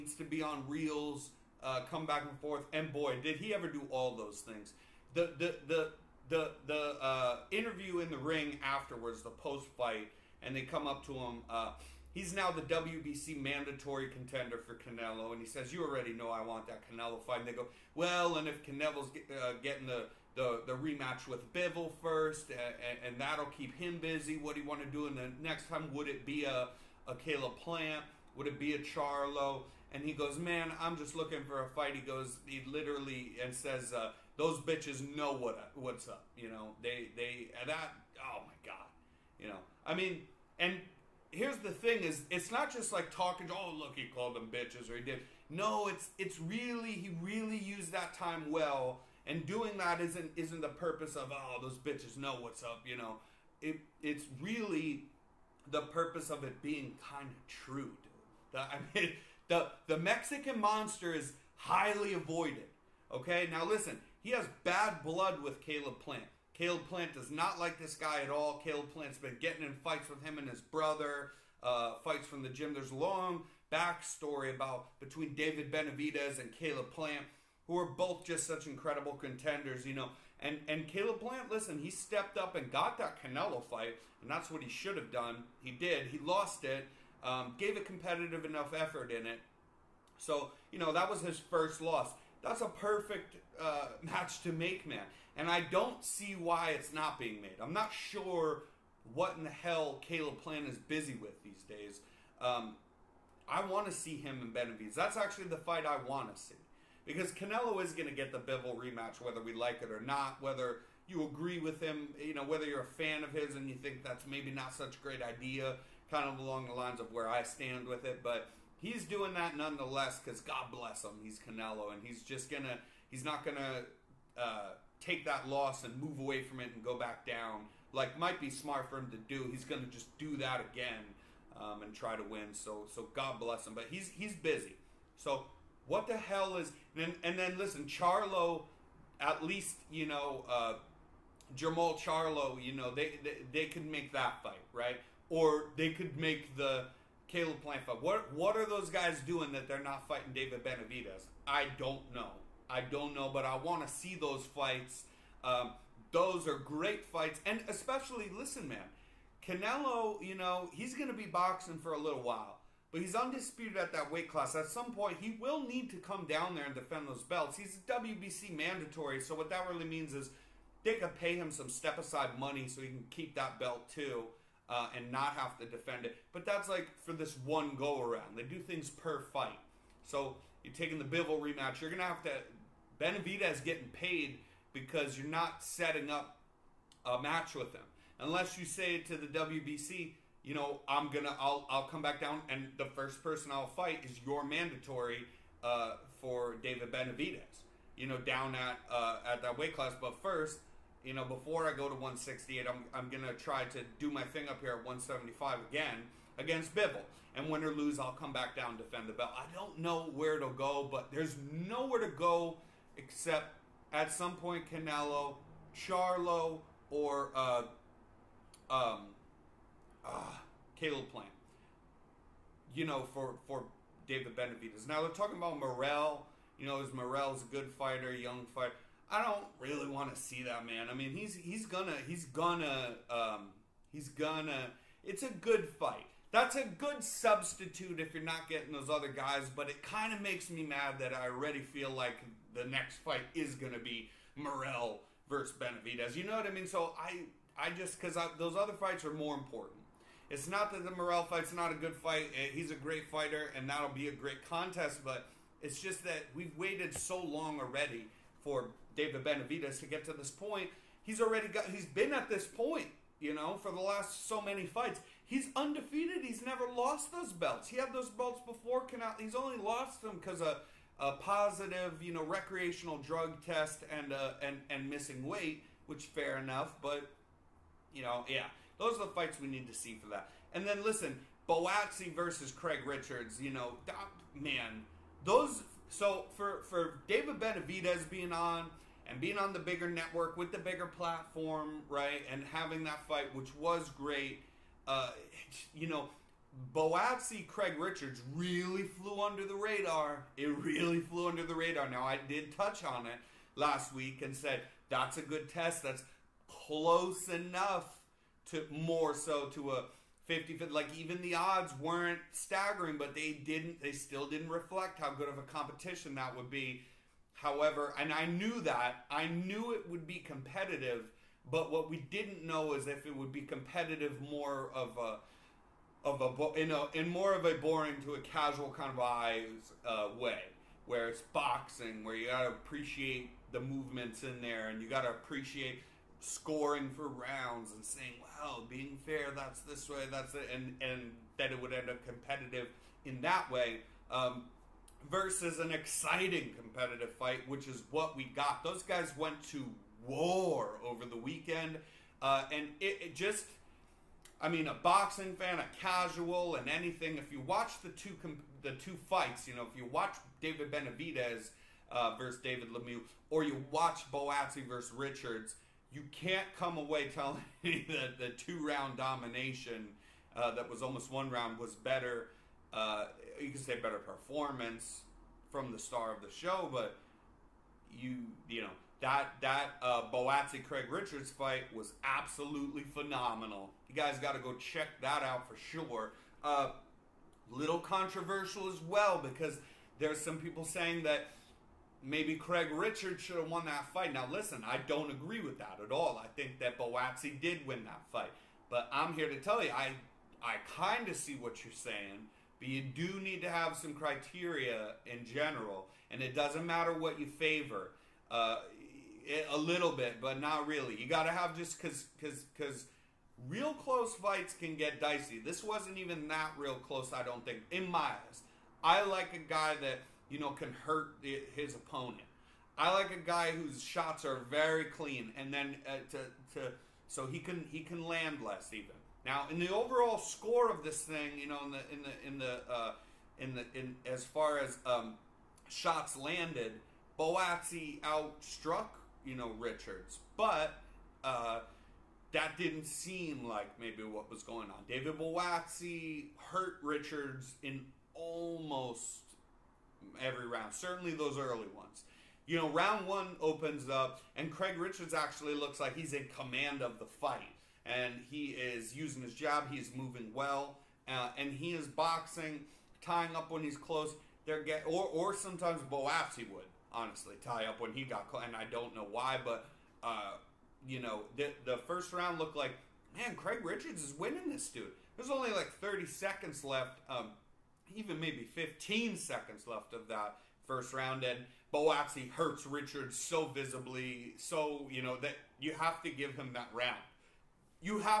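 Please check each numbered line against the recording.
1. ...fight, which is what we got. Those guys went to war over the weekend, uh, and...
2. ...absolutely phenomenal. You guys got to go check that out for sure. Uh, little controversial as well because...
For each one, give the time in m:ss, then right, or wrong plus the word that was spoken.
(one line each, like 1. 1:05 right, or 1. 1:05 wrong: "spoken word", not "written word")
1. 5:47 right
2. 6:22 right.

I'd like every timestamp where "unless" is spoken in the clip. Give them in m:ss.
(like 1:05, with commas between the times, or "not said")
3:08.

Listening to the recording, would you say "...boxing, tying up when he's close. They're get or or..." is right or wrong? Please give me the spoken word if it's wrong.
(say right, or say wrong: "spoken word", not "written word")
right.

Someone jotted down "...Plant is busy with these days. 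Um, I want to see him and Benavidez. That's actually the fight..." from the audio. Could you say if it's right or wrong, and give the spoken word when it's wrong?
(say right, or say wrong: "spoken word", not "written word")
right.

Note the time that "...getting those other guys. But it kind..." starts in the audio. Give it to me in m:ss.
3:58.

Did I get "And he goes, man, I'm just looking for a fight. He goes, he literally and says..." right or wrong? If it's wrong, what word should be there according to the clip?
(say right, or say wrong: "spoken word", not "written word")
right.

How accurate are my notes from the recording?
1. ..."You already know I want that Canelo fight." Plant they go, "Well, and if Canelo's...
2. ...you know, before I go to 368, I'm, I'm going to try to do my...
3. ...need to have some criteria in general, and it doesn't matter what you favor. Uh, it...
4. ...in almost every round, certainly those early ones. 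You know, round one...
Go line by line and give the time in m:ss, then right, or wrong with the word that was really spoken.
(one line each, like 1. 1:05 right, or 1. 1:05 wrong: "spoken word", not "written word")
1. 0:15 wrong: "And", not "Plant"
2. 3:21 wrong: "168", not "368"
3. 6:43 right
4. 7:27 right.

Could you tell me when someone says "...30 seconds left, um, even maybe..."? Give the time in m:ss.
7:55.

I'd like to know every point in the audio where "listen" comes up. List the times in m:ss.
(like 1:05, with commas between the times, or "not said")
1:03, 1:21, 2:17, 2:38, 4:40, 6:34.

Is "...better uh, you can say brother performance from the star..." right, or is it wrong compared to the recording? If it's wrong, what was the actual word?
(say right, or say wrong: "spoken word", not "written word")
wrong: "better", not "brother".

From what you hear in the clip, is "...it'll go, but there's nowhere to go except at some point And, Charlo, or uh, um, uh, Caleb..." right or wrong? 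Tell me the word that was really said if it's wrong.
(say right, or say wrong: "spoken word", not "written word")
wrong: "Canelo", not "And".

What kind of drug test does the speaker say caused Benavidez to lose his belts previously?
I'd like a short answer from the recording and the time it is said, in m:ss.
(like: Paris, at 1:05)
Recreational, at 4:32.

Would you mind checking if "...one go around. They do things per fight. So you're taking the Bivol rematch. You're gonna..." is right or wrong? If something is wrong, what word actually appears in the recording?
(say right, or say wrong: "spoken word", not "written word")
right.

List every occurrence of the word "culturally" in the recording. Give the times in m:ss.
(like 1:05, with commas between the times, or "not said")
not said.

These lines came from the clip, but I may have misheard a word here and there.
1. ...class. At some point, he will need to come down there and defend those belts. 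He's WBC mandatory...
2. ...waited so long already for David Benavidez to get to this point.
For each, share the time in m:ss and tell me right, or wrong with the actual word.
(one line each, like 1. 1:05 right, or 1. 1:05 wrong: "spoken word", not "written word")
1. 2:44 right
2. 4:16 right.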